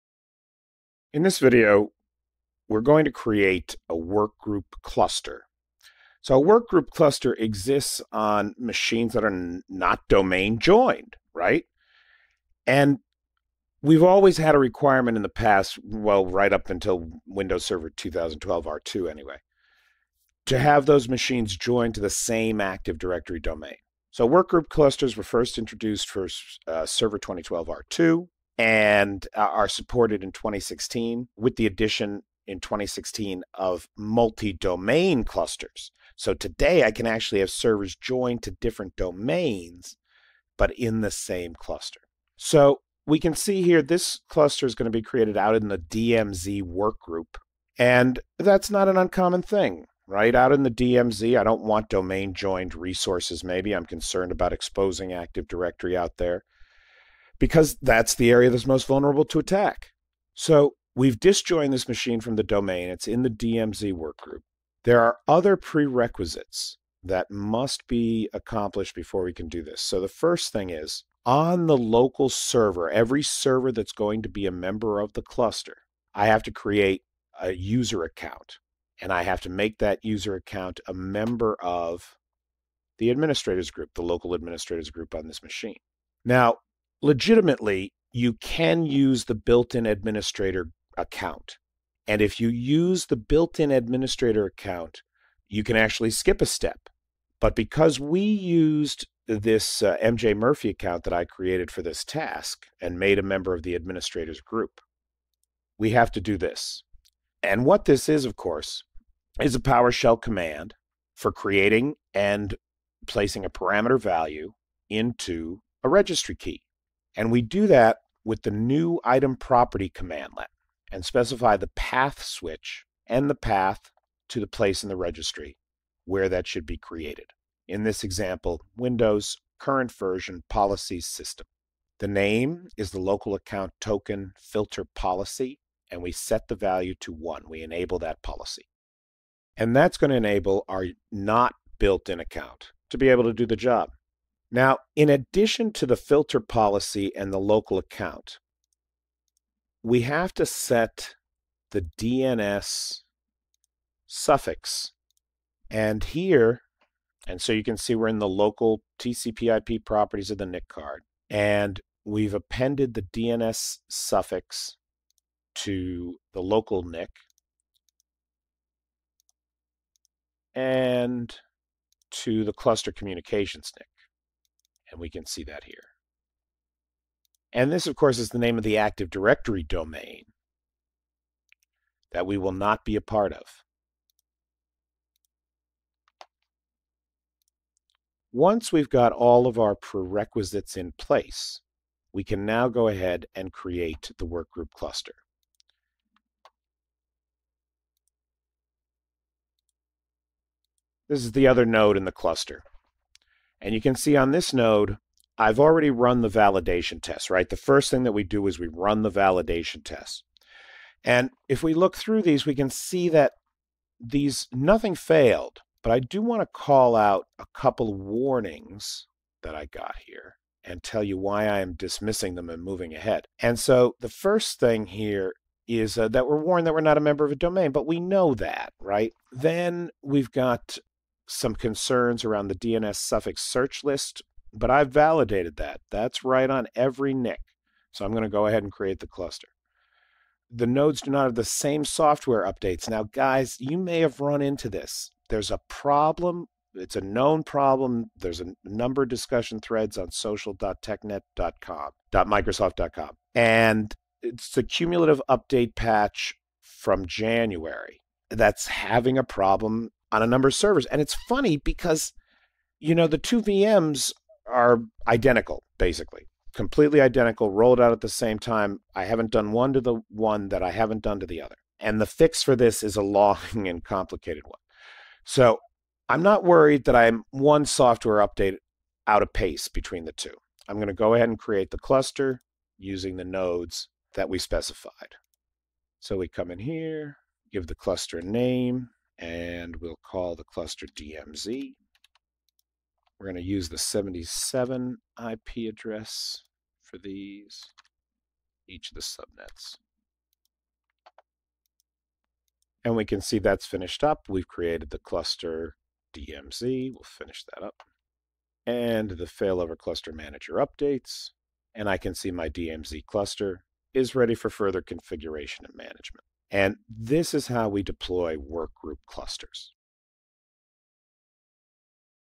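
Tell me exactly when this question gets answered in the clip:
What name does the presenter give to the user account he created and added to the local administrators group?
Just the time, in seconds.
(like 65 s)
100 s.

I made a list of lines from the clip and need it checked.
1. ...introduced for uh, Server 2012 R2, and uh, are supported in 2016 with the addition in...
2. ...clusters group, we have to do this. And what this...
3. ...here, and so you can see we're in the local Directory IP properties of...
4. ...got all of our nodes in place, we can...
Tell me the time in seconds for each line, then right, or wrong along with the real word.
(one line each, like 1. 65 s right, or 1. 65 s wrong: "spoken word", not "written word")
1. 25 s right
2. 103 s wrong: "administrators", not "clusters"
3. 156 s wrong: "TCP", not "Directory"
4. 188 s wrong: "prerequisites", not "nodes".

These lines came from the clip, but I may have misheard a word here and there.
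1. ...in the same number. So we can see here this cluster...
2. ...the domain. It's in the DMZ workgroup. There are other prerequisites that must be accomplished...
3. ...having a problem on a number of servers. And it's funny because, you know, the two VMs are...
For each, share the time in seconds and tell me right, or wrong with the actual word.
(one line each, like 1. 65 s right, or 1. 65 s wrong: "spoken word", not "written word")
1. 40 s wrong: "cluster", not "number"
2. 62 s right
3. 258 s right.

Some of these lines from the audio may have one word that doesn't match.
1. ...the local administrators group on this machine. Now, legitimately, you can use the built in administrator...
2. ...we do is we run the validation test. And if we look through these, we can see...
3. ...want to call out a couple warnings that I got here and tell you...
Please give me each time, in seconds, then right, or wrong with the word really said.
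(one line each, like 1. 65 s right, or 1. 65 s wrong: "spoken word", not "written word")
1. 83 s right
2. 208 s right
3. 216 s right.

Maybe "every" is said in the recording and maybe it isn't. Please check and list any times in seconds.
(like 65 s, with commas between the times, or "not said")
72 s, 236 s.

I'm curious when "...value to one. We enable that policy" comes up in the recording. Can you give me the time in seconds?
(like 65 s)
136 s.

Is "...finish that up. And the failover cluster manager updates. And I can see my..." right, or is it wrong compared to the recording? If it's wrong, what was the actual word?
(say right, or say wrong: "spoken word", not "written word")
right.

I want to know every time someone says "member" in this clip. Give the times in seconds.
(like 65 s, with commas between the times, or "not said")
74 s, 80 s, 103 s, 227 s.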